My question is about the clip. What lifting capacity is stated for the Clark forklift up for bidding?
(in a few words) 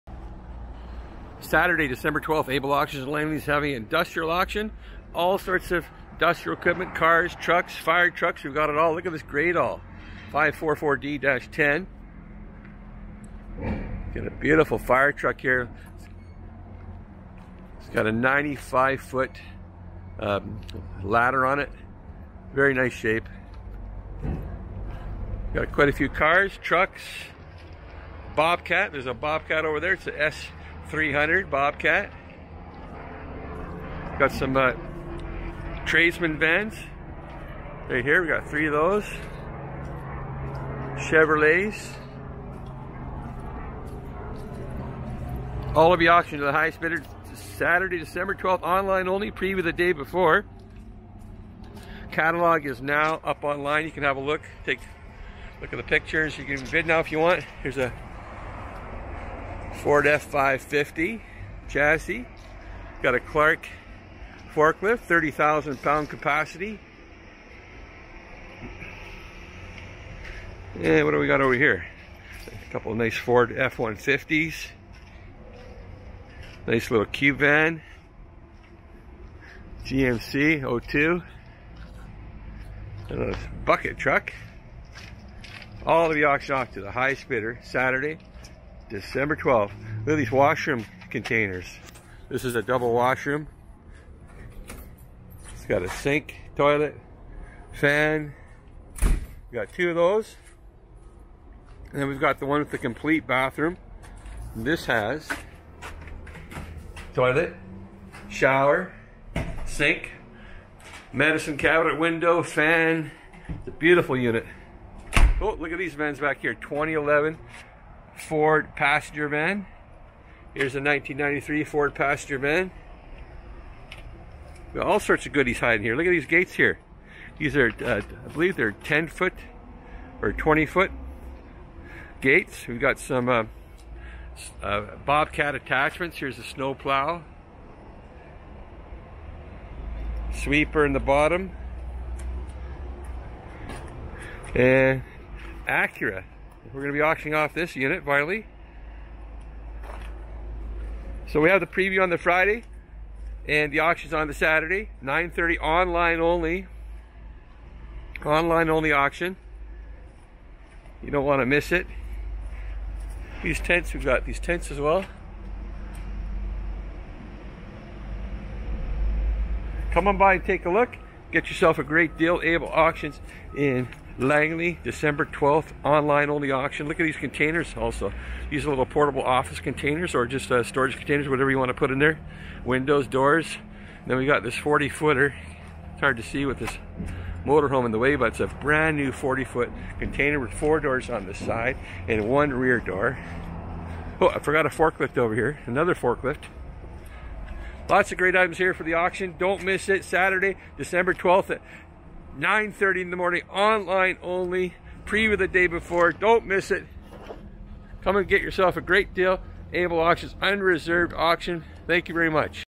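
30,000 pound.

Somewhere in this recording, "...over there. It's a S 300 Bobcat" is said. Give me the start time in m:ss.
0:29.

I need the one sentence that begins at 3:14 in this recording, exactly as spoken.
Oh, I forgot a forklift over here.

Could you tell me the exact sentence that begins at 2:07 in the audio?
These are, uh, I believe they're 10 foot or 20 foot gates.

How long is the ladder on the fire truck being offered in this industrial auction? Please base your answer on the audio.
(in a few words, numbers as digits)
95 foot.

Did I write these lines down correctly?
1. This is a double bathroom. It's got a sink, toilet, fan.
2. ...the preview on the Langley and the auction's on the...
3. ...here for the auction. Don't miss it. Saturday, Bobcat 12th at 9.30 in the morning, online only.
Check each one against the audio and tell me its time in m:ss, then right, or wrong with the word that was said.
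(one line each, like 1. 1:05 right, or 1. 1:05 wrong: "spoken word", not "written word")
1. 1:32 wrong: "washroom", not "bathroom"
2. 2:31 wrong: "Friday", not "Langley"
3. 3:18 wrong: "December", not "Bobcat".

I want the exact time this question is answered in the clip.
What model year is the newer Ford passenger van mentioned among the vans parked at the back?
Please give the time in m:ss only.
1:56.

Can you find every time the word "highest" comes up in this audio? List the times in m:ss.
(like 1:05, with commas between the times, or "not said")
0:46, 1:26.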